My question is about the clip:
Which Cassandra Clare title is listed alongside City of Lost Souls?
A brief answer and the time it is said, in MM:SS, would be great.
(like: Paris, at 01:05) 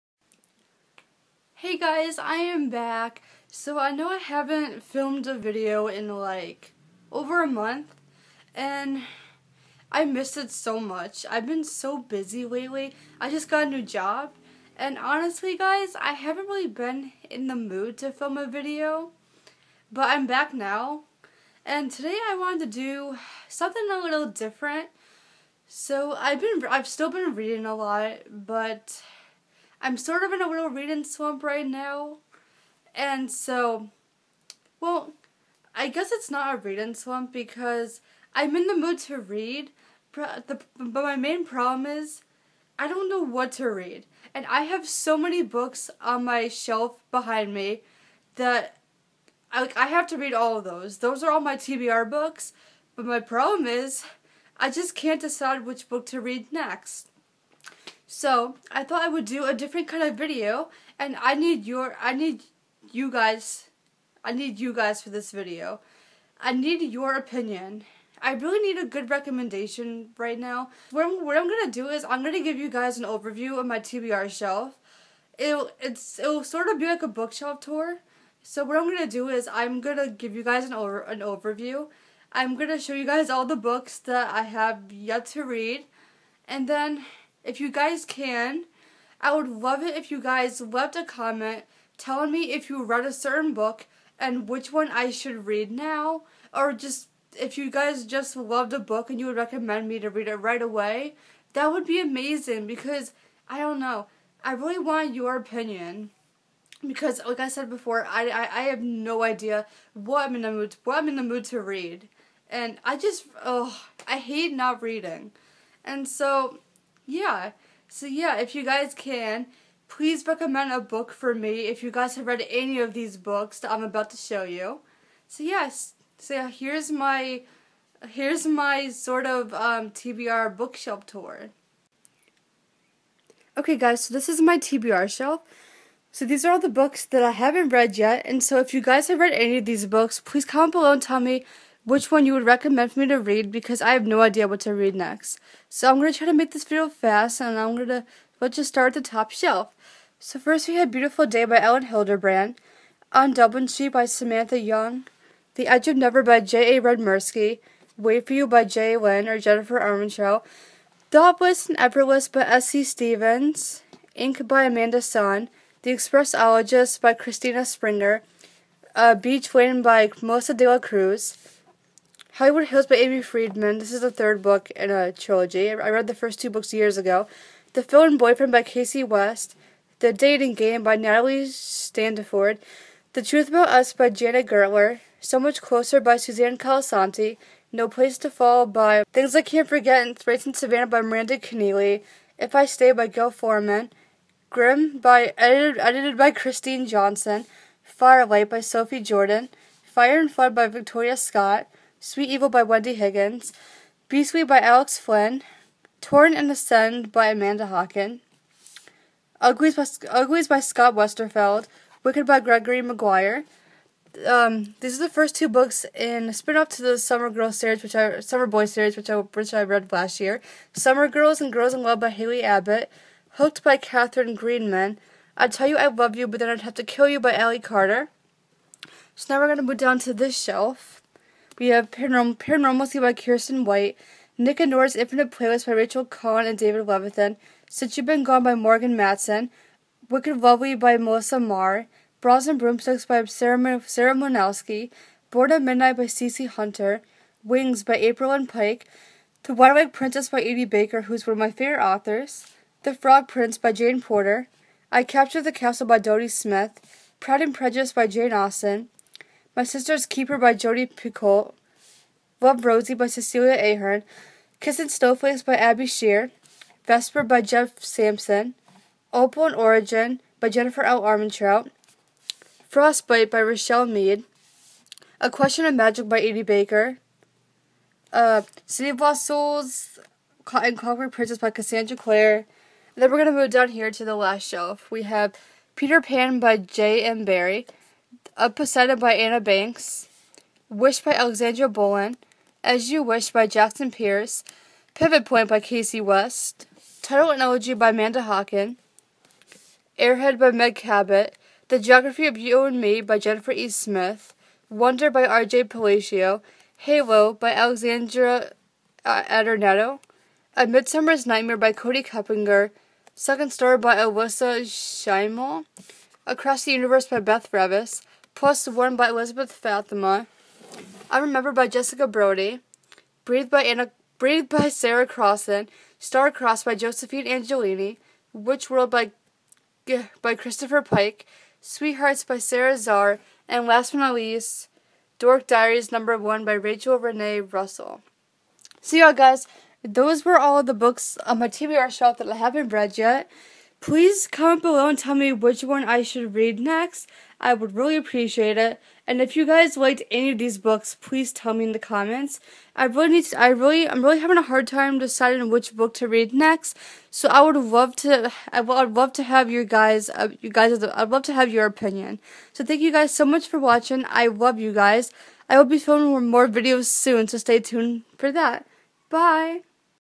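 Clockwork Princess, at 04:40.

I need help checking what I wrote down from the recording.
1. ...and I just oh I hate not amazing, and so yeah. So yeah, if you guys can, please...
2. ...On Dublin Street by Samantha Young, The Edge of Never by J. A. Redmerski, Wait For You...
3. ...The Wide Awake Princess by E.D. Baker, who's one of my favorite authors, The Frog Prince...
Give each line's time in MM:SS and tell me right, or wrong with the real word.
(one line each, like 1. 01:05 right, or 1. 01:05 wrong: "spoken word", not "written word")
1. 01:52 wrong: "reading", not "amazing"
2. 02:33 right
3. 04:09 right.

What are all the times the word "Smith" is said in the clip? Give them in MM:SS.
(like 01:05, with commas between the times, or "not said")
04:16, 05:03.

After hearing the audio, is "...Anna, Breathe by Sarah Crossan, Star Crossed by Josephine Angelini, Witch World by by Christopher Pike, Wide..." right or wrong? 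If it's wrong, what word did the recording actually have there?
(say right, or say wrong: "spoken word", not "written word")
wrong: "Sweethearts", not "Wide".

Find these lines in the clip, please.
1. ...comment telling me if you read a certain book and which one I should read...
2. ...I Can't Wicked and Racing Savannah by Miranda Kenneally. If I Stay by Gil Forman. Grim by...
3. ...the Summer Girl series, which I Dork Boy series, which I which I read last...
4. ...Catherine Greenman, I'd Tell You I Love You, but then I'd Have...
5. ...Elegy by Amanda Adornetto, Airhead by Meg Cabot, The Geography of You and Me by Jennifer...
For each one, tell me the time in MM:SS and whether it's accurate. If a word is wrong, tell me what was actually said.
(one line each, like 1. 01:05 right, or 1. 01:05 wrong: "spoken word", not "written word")
1. 01:31 right
2. 03:09 wrong: "Forget", not "Wicked"
3. 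03:36 wrong: "Summer", not "Dork"
4. 03:43 right
5. 04:57 wrong: "Hocking", not "Adornetto".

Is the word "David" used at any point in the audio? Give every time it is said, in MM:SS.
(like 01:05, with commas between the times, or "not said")
03:56.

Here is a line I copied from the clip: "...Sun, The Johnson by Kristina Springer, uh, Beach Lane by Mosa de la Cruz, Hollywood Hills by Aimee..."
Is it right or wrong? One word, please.
wrong.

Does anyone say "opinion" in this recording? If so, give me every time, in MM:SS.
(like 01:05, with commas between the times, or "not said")
01:07, 01:45, 06:01.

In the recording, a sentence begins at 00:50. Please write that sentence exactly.
Those are all my TBR books, but my problem is I just can't decide which book to read next.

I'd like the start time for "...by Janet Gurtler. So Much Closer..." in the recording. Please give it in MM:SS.
03:03.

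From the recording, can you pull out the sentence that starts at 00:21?
And today I wanted to do something a little different.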